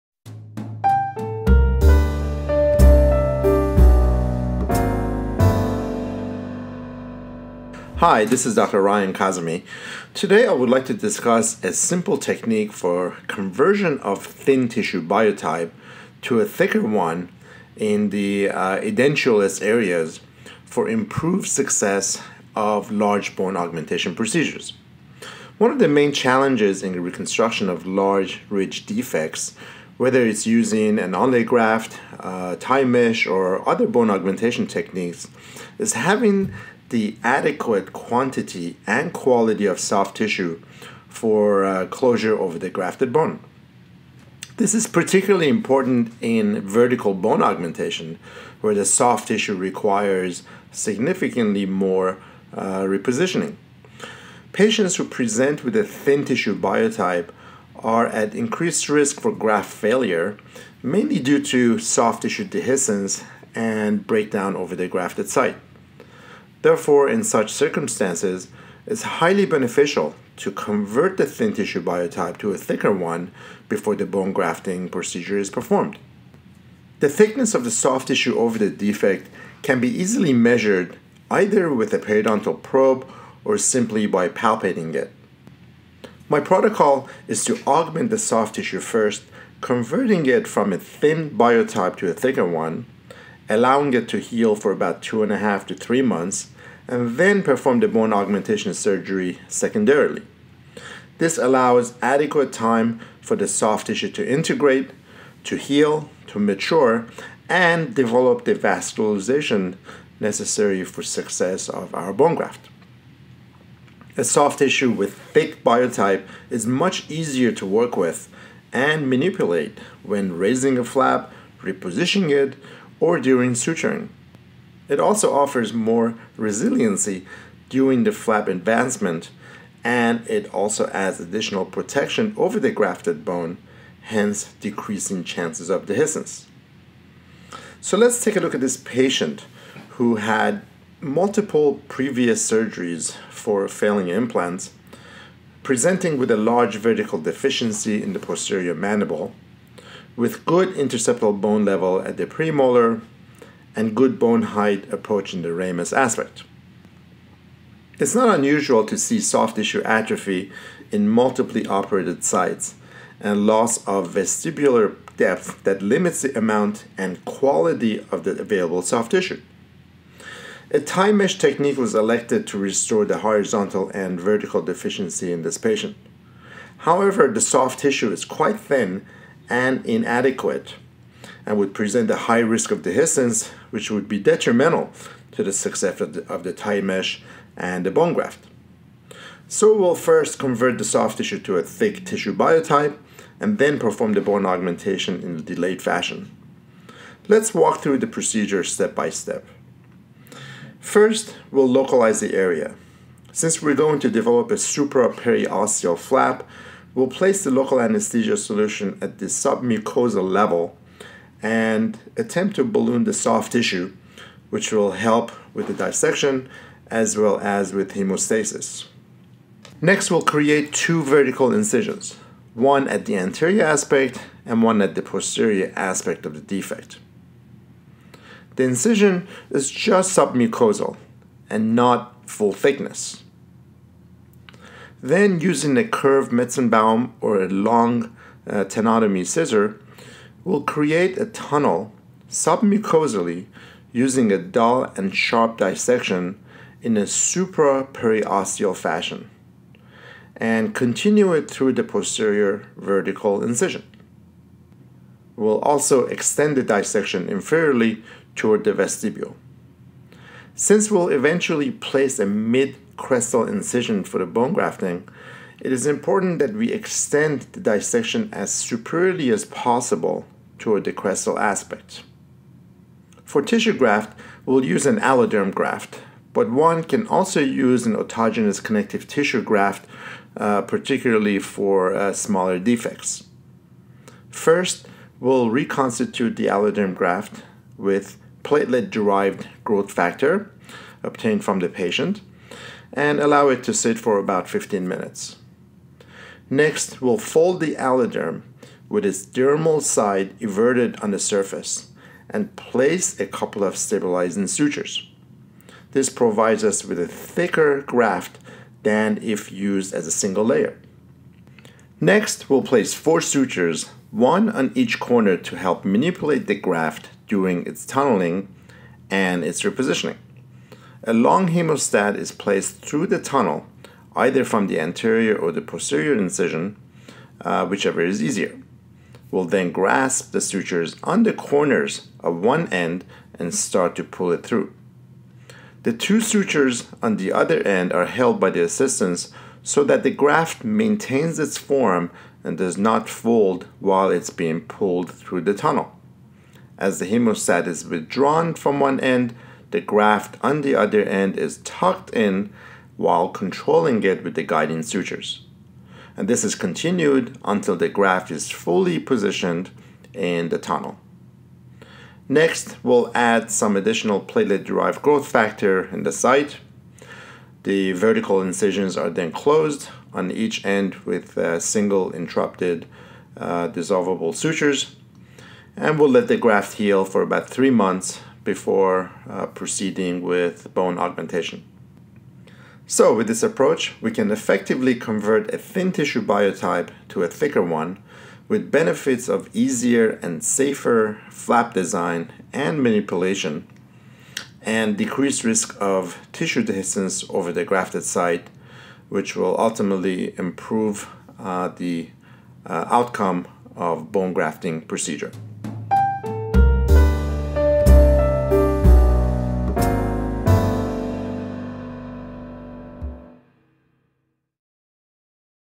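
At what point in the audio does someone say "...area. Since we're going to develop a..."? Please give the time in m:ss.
3:22.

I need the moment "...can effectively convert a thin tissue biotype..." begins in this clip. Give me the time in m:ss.
6:24.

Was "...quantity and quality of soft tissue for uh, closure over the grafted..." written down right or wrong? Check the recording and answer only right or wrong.
right.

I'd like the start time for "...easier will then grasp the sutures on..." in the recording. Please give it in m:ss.
5:28.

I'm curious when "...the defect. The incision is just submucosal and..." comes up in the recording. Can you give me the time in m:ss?
3:46.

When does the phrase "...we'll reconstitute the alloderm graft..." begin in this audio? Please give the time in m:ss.
4:45.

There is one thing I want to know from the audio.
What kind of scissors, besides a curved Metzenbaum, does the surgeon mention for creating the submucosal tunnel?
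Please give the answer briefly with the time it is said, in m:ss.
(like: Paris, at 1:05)
Tenotomy scissor, at 3:58.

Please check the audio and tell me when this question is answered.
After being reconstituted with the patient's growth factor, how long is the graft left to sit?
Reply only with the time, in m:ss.
4:54.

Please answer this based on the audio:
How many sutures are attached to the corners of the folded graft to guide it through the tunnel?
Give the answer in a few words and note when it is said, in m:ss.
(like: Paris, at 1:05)
4, at 5:12.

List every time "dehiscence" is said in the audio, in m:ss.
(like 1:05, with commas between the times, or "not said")
1:02, 2:15, 3:02, 6:36.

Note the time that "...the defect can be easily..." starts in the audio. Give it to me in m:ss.
1:18.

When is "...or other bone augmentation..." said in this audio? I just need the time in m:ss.
0:33.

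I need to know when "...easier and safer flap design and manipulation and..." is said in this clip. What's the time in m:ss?
6:29.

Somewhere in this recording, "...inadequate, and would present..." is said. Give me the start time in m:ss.
2:59.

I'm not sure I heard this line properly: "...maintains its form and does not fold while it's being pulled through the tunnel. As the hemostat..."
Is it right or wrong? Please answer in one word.
right.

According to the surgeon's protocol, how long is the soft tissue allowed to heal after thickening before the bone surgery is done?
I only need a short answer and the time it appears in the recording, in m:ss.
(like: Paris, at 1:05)
2.5 to 3 months, at 1:35.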